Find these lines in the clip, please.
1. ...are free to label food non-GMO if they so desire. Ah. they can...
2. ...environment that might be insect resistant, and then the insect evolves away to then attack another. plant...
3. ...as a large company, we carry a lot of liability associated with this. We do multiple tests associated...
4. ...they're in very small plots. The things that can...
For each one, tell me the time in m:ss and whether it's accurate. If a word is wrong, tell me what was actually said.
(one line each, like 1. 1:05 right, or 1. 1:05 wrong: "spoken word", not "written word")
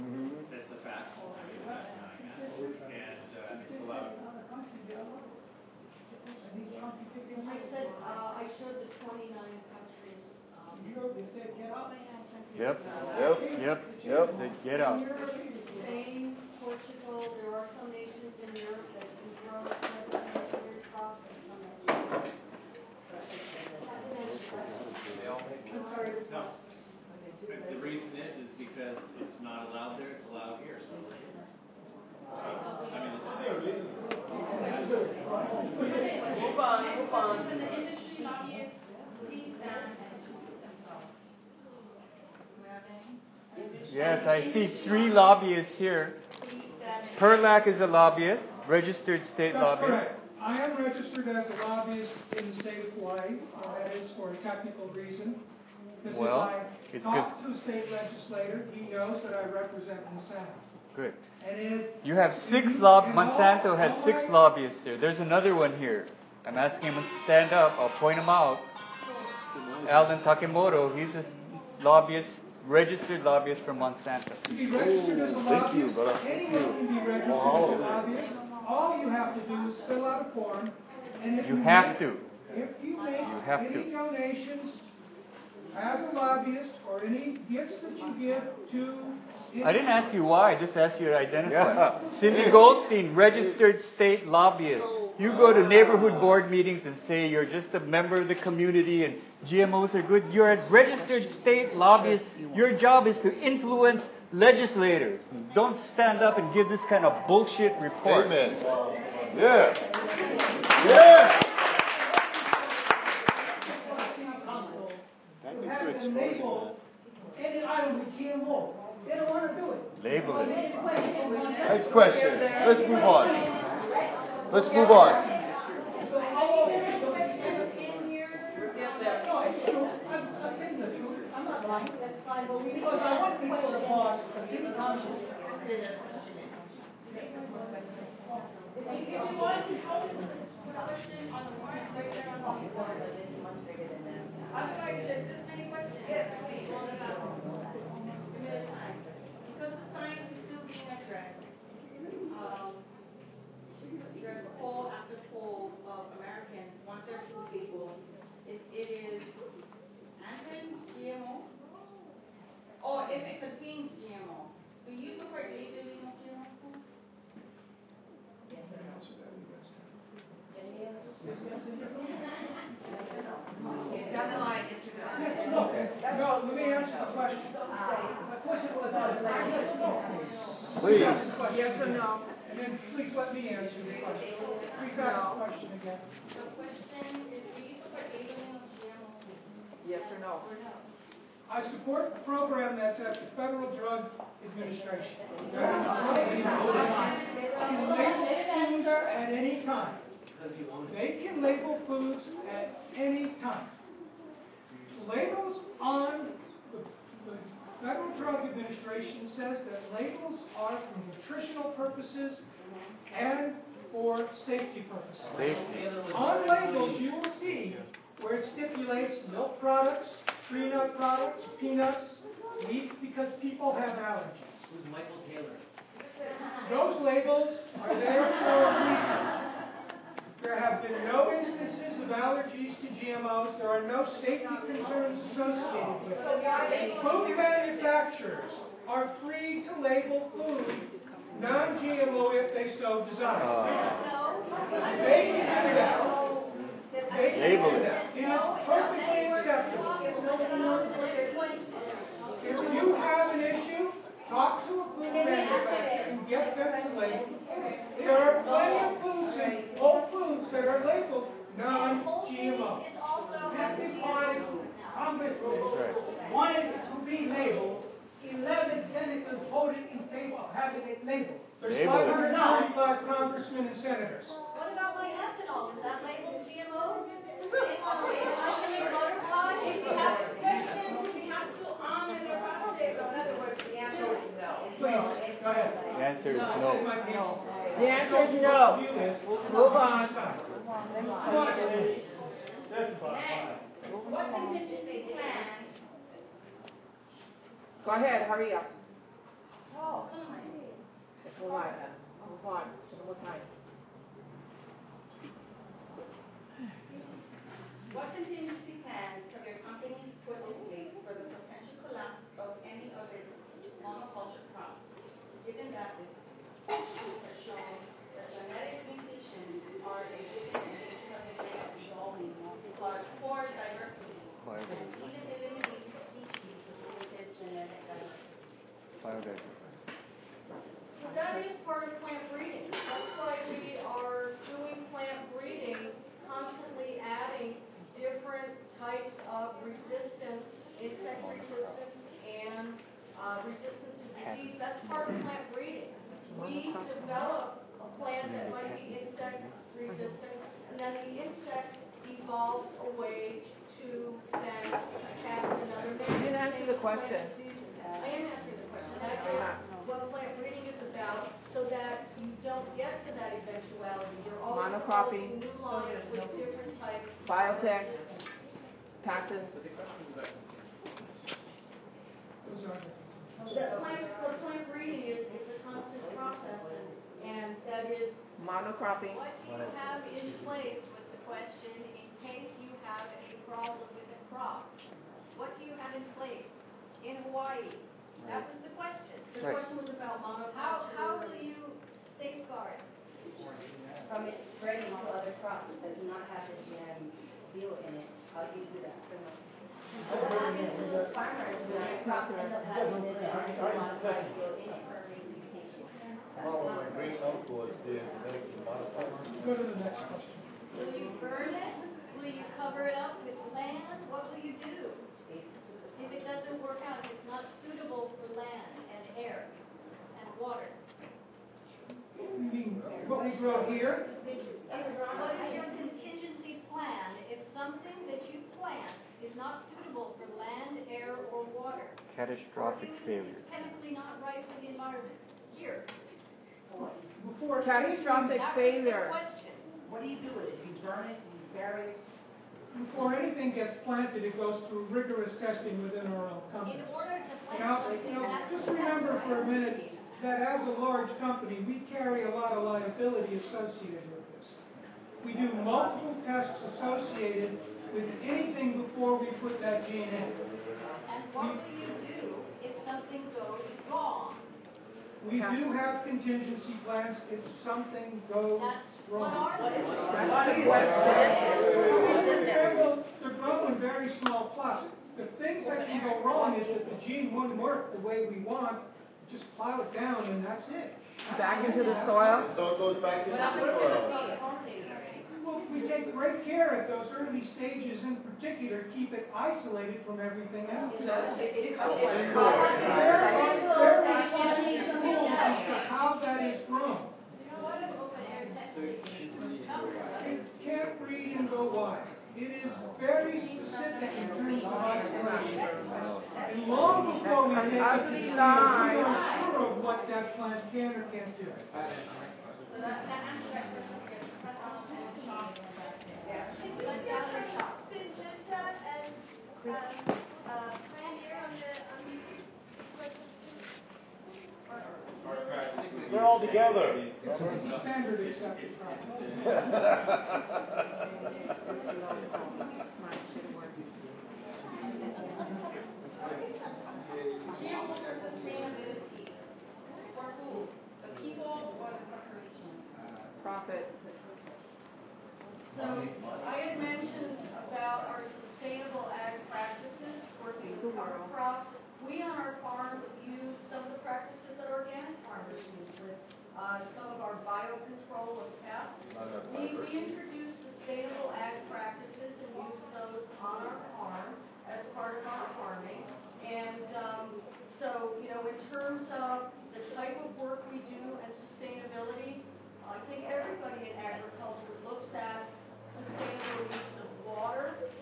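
1. 3:58 right
2. 5:48 wrong: "plant", not "environment"
3. 7:30 right
4. 7:49 right.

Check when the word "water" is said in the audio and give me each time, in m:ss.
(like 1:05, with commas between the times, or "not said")
7:00, 7:11, 9:37.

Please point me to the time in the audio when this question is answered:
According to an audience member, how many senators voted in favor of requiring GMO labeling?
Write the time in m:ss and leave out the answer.
4:28.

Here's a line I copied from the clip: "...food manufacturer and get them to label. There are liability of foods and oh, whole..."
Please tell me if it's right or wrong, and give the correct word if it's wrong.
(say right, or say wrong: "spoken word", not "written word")
wrong: "plenty", not "liability".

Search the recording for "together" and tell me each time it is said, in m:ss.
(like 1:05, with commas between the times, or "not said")
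8:46.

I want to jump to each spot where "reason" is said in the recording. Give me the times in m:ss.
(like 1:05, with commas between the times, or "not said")
0:54, 3:49.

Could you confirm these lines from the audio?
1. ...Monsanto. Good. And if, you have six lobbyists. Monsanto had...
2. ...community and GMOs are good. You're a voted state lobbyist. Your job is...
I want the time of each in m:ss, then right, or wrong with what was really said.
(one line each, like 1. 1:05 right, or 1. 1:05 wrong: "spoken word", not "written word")
1. 1:00 right
2. 1:38 wrong: "registered", not "voted".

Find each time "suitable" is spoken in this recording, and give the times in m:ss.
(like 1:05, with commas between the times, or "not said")
6:57, 7:09.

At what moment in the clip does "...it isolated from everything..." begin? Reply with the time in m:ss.
8:09.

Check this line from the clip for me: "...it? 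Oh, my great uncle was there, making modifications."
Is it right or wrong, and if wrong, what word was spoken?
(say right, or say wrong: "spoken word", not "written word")
right.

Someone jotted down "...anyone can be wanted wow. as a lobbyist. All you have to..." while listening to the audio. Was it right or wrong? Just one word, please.
wrong.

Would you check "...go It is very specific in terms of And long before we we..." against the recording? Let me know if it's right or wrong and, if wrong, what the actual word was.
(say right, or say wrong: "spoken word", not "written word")
right.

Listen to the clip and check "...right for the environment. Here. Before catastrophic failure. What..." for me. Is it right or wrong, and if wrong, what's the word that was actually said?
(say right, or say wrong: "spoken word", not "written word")
right.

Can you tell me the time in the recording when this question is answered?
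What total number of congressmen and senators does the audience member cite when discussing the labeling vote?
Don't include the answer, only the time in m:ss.
4:31.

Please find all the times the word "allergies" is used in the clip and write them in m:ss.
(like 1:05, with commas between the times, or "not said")
3:43, 3:52.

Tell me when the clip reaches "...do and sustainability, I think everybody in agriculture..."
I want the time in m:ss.
9:30.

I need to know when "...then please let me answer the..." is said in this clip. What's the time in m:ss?
3:02.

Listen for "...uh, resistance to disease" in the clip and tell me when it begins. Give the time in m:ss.
5:43.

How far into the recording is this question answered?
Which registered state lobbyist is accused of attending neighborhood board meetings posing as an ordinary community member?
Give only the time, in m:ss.
1:32.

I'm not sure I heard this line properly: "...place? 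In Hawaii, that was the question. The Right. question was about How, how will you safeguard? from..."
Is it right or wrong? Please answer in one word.
right.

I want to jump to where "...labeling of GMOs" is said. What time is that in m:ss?
3:08.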